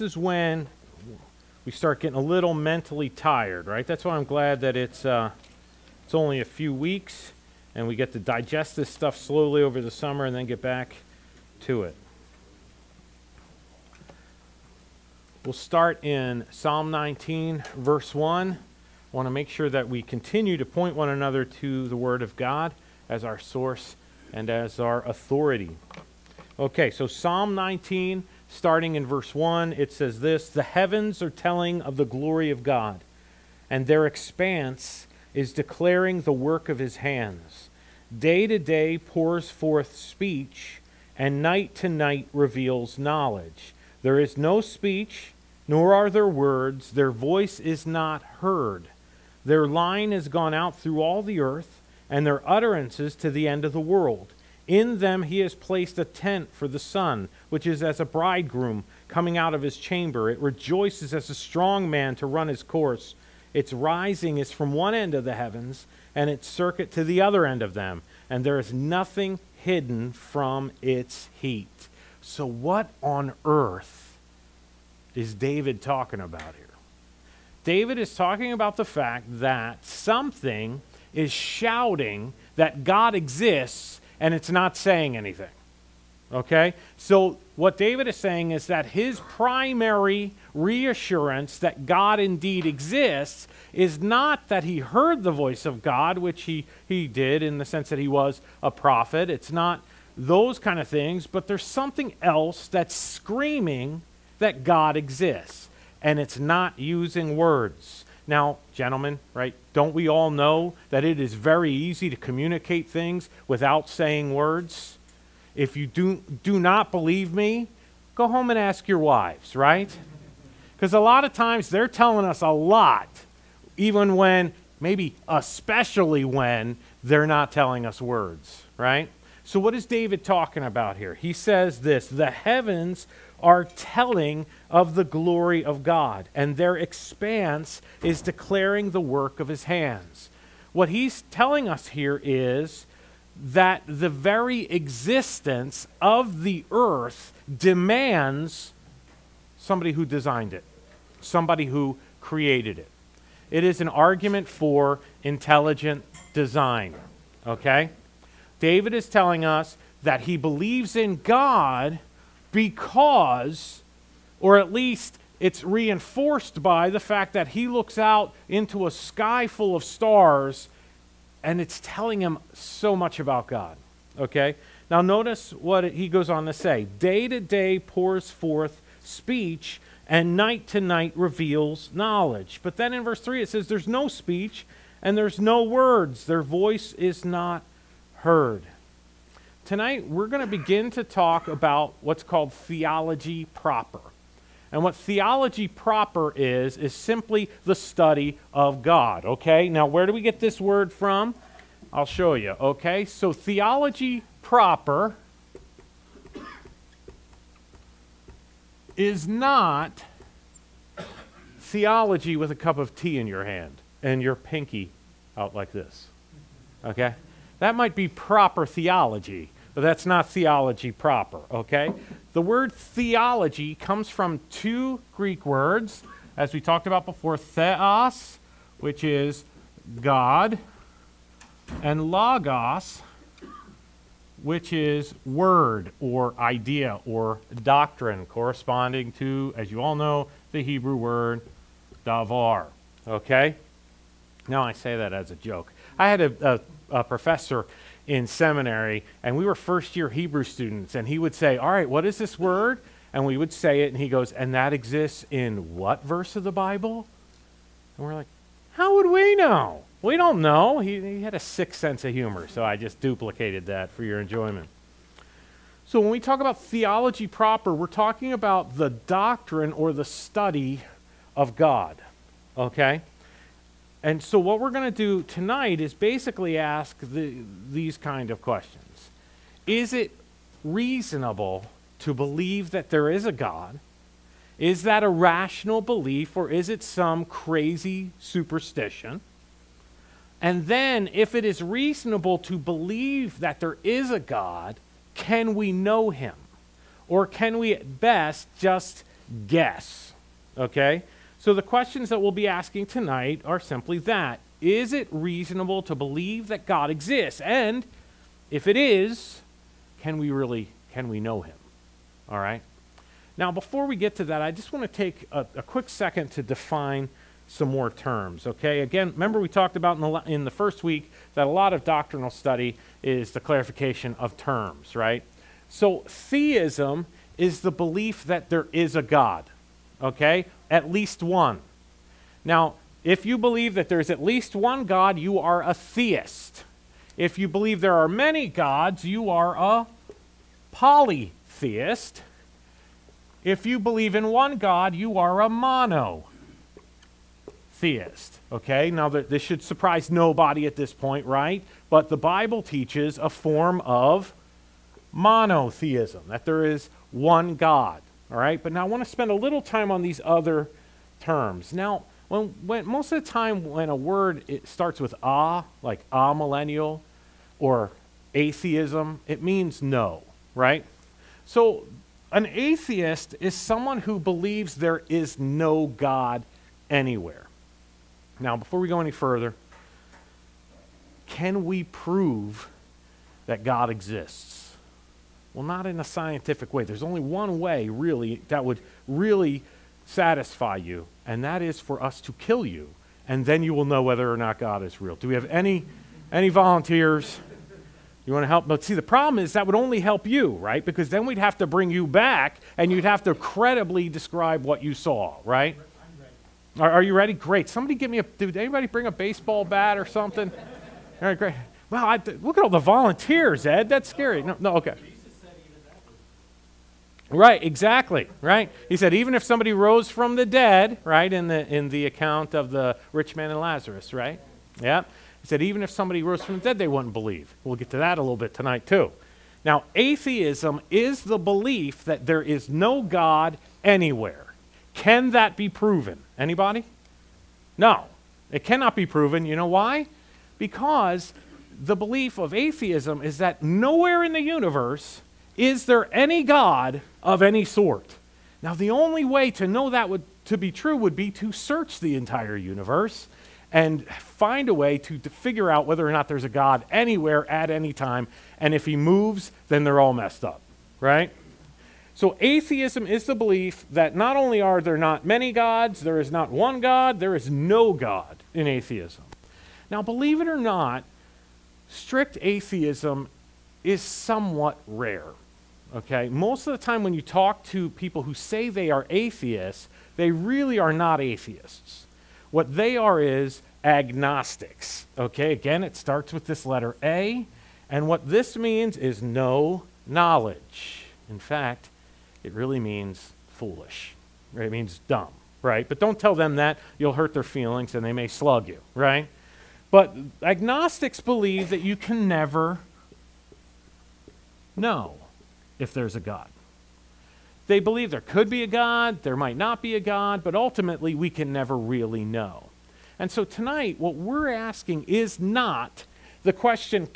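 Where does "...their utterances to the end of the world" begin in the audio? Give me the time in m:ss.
0:52.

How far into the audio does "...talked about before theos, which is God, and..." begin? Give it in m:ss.
3:46.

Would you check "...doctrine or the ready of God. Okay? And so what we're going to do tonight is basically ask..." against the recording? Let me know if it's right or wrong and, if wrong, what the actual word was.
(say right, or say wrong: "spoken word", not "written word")
wrong: "study", not "ready".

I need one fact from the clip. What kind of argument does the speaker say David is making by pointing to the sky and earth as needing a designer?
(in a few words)
Intelligent design.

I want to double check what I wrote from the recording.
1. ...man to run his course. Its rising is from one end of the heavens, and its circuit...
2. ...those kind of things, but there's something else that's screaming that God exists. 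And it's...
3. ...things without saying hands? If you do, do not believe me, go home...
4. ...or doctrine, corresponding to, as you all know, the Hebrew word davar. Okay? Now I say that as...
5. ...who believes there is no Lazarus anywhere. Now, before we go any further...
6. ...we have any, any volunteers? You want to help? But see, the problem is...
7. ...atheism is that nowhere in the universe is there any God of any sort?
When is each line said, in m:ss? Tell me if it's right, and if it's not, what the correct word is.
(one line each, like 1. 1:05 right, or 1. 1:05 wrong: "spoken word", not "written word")
1. 1:01 right
2. 1:40 right
3. 1:52 wrong: "words", not "hands"
4. 3:57 right
5. 6:14 wrong: "God", not "Lazarus"
6. 6:35 right
7. 7:22 right.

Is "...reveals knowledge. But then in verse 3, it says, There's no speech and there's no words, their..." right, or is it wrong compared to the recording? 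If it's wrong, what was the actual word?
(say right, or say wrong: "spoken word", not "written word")
right.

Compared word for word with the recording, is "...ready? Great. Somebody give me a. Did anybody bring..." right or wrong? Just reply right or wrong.
right.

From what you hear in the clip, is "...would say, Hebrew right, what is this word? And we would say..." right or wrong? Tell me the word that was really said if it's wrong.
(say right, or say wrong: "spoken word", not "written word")
wrong: "All", not "Hebrew".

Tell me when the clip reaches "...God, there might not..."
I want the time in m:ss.
8:28.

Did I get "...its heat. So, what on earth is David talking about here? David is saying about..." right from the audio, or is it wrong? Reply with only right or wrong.
wrong.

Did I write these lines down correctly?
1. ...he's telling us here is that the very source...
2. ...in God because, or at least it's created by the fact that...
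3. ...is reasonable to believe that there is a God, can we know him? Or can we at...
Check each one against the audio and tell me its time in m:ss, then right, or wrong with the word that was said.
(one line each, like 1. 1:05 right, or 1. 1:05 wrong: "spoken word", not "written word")
1. 2:20 wrong: "existence", not "source"
2. 2:40 wrong: "reinforced", not "created"
3. 4:51 right.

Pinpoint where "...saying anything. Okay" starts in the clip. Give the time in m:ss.
1:24.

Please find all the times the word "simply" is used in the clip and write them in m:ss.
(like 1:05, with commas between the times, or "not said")
3:16, 5:03.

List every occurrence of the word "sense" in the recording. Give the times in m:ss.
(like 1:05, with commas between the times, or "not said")
1:37, 4:21.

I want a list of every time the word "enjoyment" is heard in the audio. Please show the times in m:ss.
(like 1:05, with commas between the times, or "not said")
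4:24.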